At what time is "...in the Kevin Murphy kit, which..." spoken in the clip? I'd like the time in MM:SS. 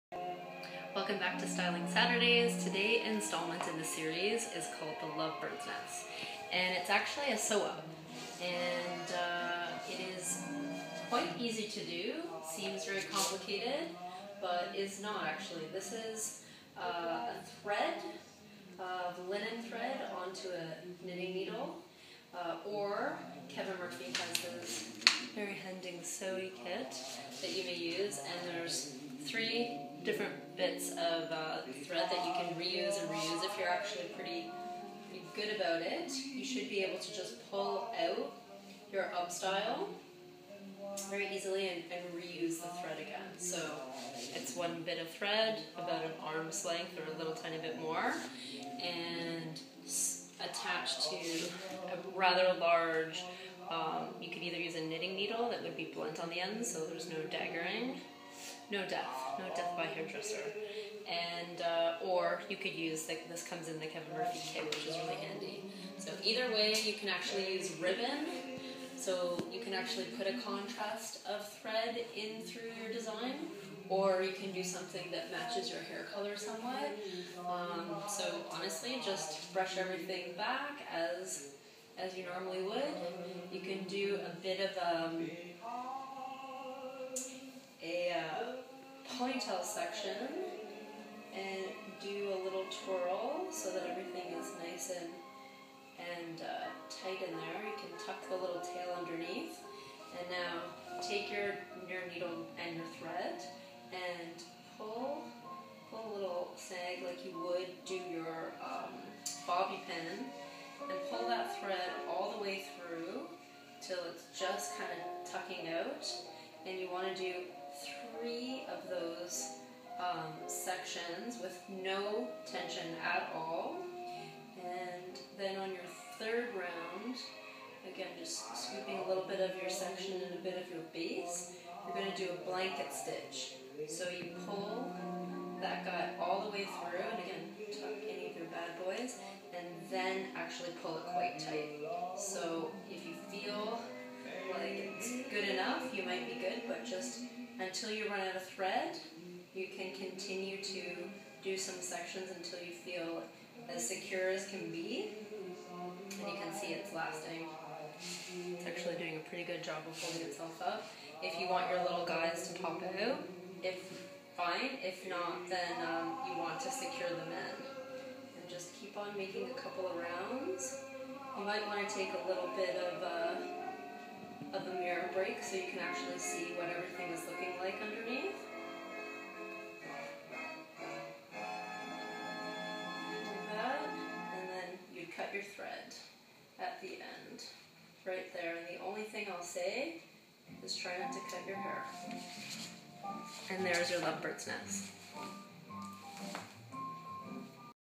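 01:03.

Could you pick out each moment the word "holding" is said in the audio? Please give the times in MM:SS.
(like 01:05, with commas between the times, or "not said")
02:40.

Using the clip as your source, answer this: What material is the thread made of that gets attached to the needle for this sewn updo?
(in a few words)
linen.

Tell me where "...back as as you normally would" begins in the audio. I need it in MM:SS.
01:20.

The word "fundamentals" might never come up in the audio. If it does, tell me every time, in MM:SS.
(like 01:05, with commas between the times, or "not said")
not said.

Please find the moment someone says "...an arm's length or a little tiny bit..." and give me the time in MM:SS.
00:46.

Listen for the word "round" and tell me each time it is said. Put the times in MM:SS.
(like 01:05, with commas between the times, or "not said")
02:06, 02:49.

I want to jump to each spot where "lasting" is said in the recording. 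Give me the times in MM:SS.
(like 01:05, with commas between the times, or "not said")
02:36.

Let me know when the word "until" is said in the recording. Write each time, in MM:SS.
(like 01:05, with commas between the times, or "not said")
02:27, 02:32.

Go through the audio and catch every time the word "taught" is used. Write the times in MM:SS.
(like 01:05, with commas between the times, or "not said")
not said.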